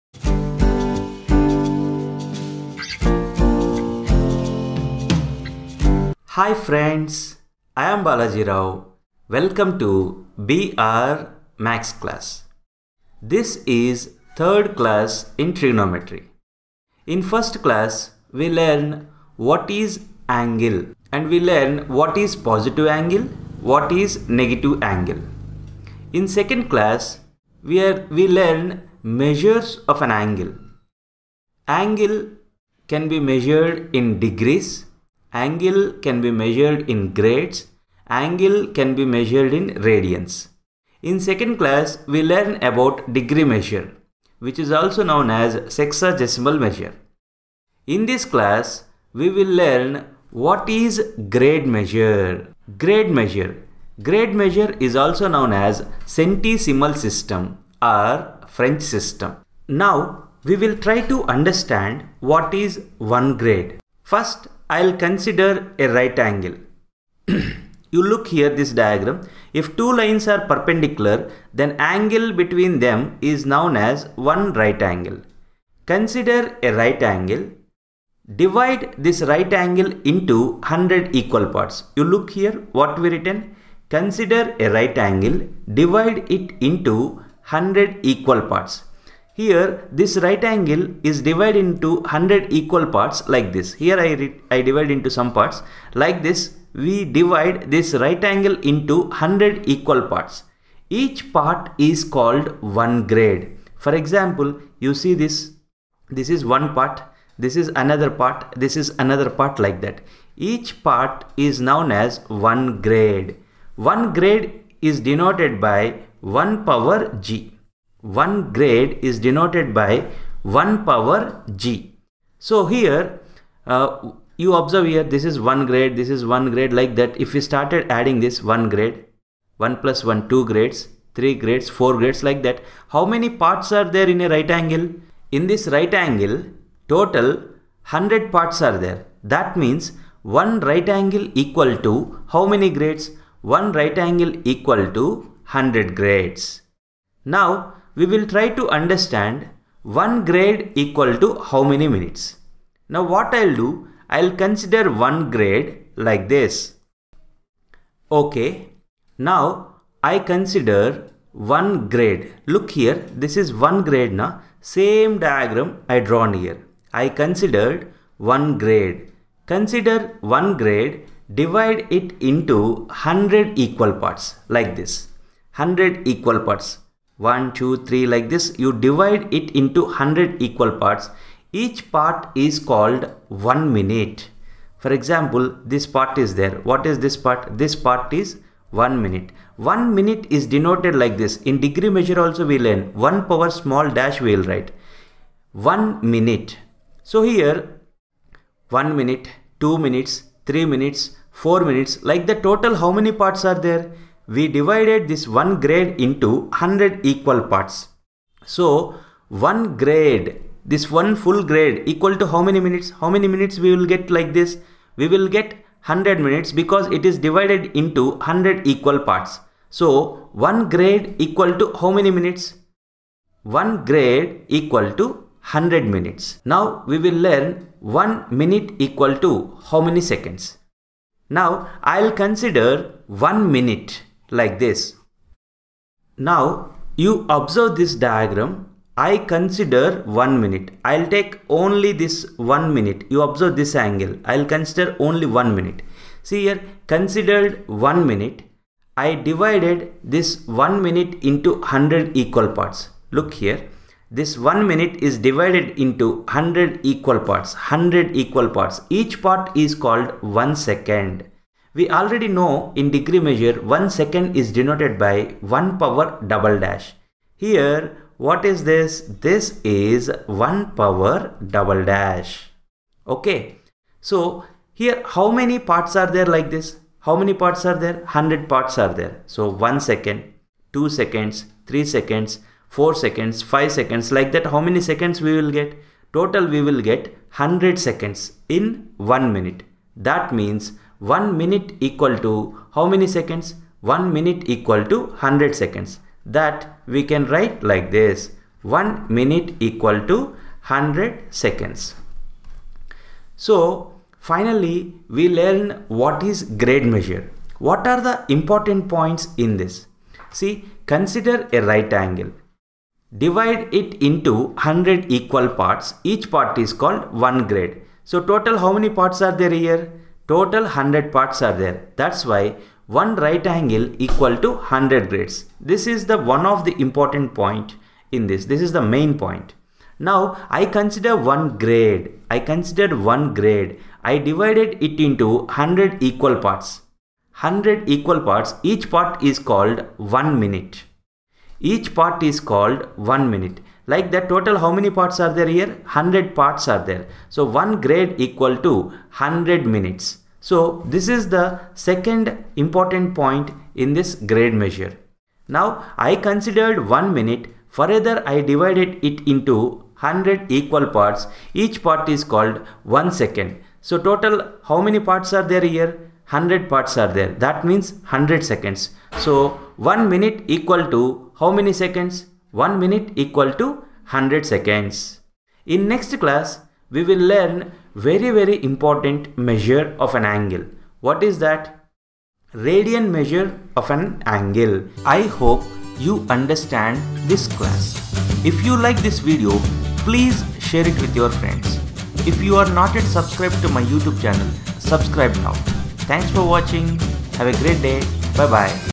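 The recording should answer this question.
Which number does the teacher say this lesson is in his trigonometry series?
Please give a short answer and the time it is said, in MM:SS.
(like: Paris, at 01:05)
third, at 00:14.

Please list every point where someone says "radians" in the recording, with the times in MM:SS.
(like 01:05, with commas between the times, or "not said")
00:39, 06:22.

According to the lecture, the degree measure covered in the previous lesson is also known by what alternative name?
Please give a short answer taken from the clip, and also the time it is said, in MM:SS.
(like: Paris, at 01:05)
sexagesimal measure, at 00:45.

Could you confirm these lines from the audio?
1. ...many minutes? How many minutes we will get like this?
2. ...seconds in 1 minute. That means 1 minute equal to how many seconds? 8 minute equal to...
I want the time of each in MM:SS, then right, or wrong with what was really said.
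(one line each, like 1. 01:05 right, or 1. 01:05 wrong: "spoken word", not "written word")
1. 03:32 right
2. 04:47 wrong: "1", not "8".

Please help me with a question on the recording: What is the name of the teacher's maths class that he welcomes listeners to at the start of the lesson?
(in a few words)
BR Maths.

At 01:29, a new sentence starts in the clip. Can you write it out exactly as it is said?
Here this right angle is divided into 100 equal parts like this.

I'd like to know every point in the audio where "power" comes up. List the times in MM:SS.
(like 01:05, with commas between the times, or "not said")
01:56, 02:00, 03:13, 04:25, 04:30.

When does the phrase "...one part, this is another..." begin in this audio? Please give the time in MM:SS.
01:46.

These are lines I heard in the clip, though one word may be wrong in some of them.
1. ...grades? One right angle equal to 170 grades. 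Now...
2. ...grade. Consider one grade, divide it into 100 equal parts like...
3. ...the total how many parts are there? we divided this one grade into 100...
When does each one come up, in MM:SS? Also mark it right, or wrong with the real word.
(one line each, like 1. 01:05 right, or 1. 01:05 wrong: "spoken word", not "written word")
1. 02:22 wrong: "100", not "170"
2. 02:48 right
3. 03:22 right.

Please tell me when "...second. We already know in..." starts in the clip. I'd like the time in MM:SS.
04:20.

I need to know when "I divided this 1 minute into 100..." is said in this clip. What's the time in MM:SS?
04:08.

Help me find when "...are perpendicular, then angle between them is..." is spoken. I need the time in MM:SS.
01:10.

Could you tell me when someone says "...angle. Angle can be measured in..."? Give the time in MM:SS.
00:30.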